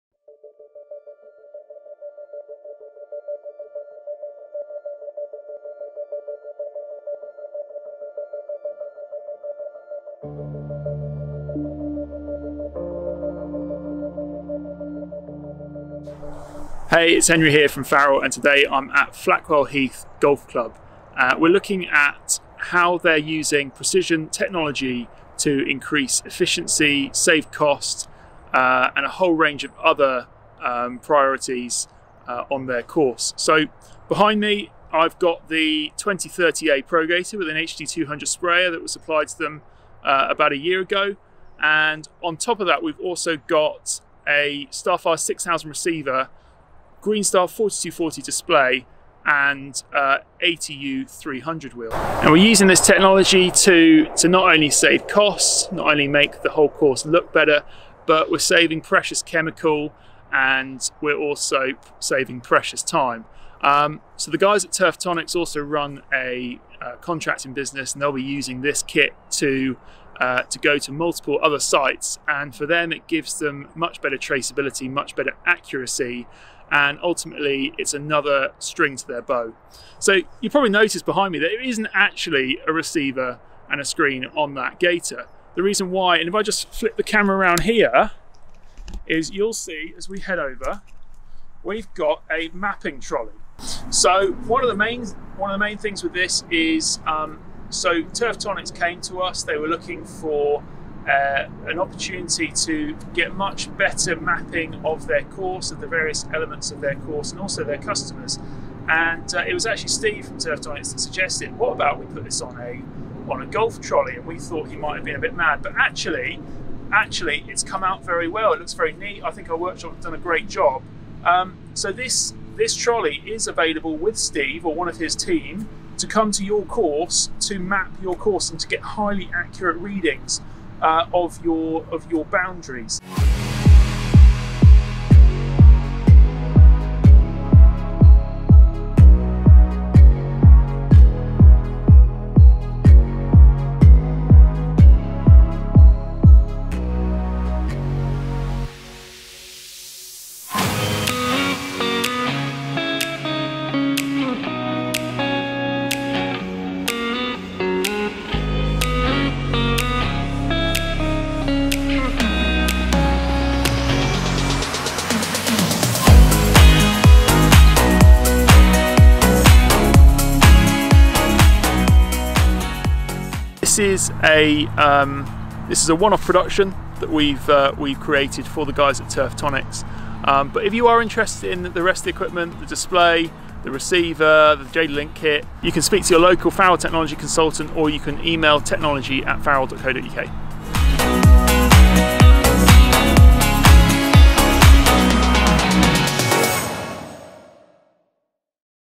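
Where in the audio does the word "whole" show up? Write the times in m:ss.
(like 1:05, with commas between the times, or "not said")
0:29, 0:56.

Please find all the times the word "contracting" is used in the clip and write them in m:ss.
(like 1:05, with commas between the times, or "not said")
1:06.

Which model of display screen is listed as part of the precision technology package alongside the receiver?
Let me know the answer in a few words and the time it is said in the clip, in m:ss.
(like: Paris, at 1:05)
Green Star 4240, at 0:47.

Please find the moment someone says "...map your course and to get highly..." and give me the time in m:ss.
2:07.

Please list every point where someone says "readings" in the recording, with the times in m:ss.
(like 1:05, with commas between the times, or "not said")
2:09.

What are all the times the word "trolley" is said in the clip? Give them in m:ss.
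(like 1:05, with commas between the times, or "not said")
1:32, 1:53, 2:02.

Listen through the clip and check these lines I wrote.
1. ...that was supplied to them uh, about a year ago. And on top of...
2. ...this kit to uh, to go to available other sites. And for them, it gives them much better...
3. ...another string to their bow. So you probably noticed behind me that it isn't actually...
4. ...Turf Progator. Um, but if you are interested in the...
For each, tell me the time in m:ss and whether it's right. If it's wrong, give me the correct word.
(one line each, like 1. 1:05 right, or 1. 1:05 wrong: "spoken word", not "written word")
1. 0:38 right
2. 1:08 wrong: "multiple", not "available"
3. 1:17 right
4. 2:59 wrong: "Tonics", not "Progator".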